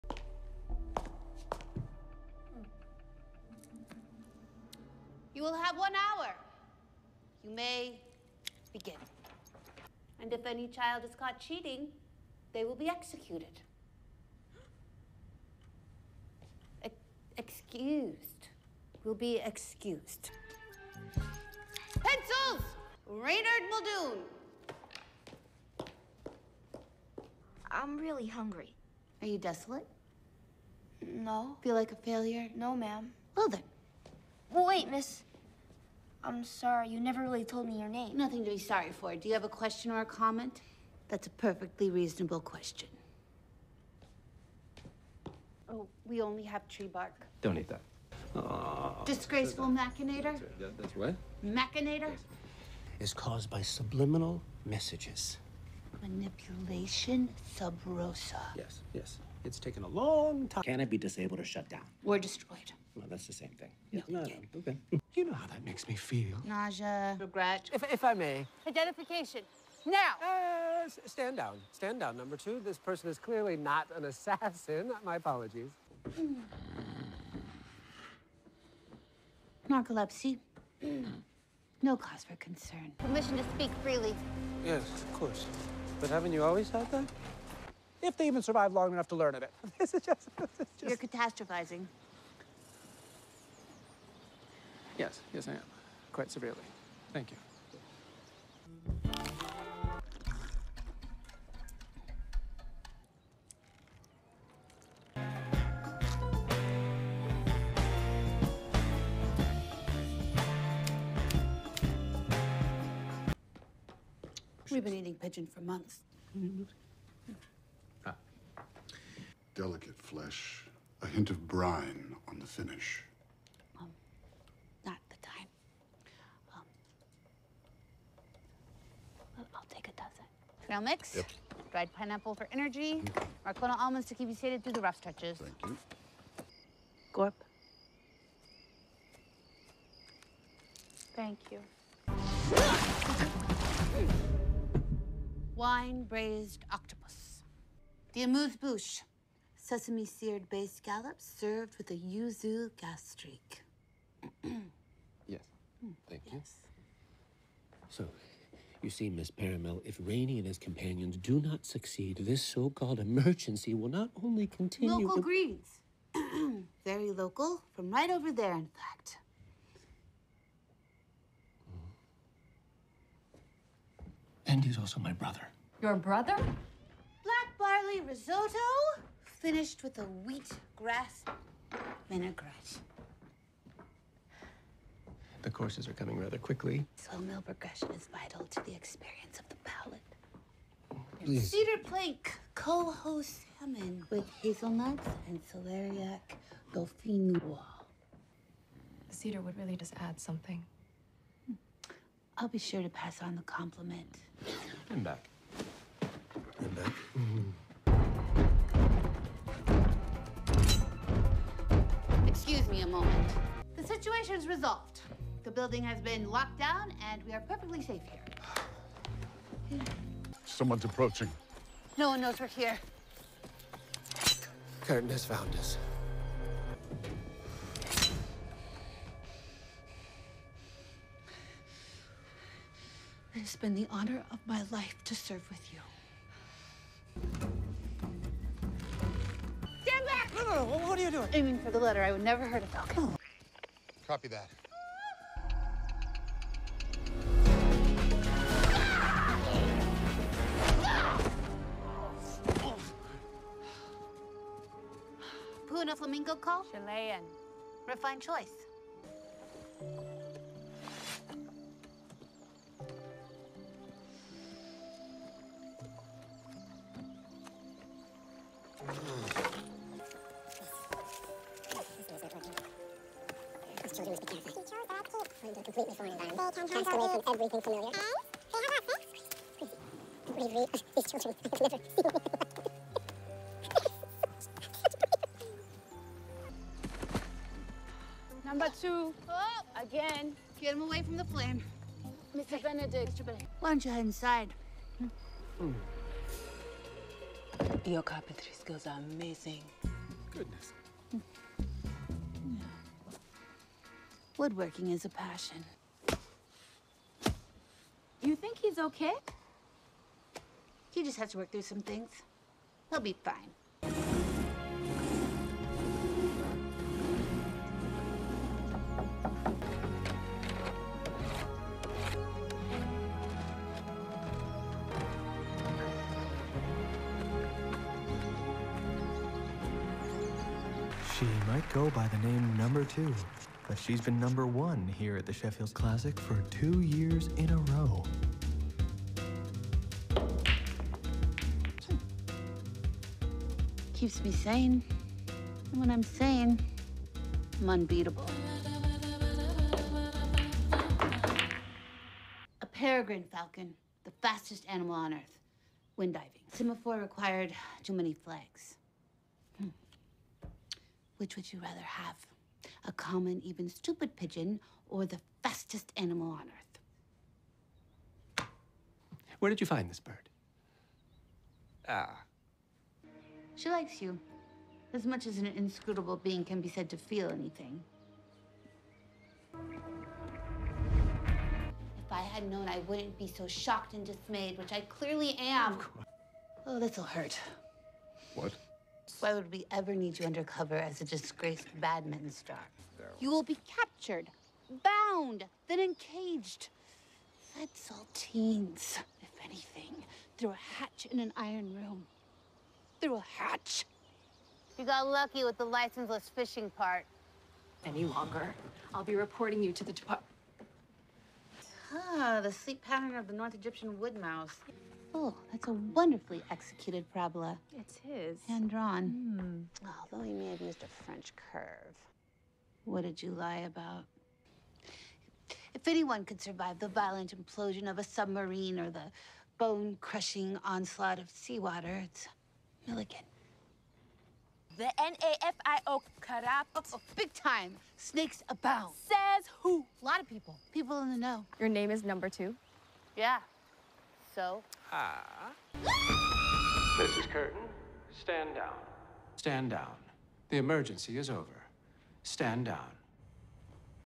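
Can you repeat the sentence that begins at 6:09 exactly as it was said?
Where did you find this bird?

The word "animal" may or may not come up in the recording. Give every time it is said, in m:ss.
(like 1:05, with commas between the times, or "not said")
5:54, 6:05.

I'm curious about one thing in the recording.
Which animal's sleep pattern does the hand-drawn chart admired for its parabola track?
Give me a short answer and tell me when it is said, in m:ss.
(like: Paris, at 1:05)
North Egyptian wood mouse, at 6:53.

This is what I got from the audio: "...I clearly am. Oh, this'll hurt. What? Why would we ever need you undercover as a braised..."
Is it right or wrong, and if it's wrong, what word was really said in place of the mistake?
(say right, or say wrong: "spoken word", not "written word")
wrong: "disgraced", not "braised".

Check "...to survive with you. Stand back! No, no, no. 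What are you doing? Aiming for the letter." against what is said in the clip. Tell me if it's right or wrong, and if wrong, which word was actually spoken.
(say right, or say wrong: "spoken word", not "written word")
wrong: "serve", not "survive".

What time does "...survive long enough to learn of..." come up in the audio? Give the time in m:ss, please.
1:28.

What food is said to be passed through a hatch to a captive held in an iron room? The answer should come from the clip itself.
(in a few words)
Saltines.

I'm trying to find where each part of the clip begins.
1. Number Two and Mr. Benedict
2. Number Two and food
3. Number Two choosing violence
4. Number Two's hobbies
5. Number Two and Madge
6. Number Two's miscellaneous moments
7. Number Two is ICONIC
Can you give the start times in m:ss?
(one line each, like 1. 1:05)
1. 0:46
2. 1:38
3. 3:28
4. 4:19
5. 5:53
6. 6:20
7. 7:21.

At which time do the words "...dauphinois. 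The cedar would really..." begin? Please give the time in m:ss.
3:16.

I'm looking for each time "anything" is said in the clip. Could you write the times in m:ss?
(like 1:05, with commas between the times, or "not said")
6:17, 6:39.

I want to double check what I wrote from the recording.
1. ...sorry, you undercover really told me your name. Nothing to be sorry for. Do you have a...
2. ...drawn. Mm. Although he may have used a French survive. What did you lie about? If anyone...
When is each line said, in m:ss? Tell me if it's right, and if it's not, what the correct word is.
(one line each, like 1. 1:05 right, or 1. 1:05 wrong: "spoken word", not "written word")
1. 0:36 wrong: "never", not "undercover"
2. 6:58 wrong: "curve", not "survive".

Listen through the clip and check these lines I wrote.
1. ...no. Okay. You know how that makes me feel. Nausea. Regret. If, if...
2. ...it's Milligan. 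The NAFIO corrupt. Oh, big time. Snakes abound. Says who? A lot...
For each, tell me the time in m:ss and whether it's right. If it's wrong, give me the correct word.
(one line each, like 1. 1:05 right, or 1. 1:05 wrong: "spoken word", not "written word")
1. 1:04 right
2. 7:12 right.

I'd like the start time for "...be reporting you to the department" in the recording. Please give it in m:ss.
6:49.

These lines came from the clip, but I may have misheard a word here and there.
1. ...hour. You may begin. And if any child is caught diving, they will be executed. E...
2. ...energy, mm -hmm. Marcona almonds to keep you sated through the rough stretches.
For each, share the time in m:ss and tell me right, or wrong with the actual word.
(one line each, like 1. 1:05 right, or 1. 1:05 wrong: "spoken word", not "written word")
1. 0:05 wrong: "cheating", not "diving"
2. 2:12 right.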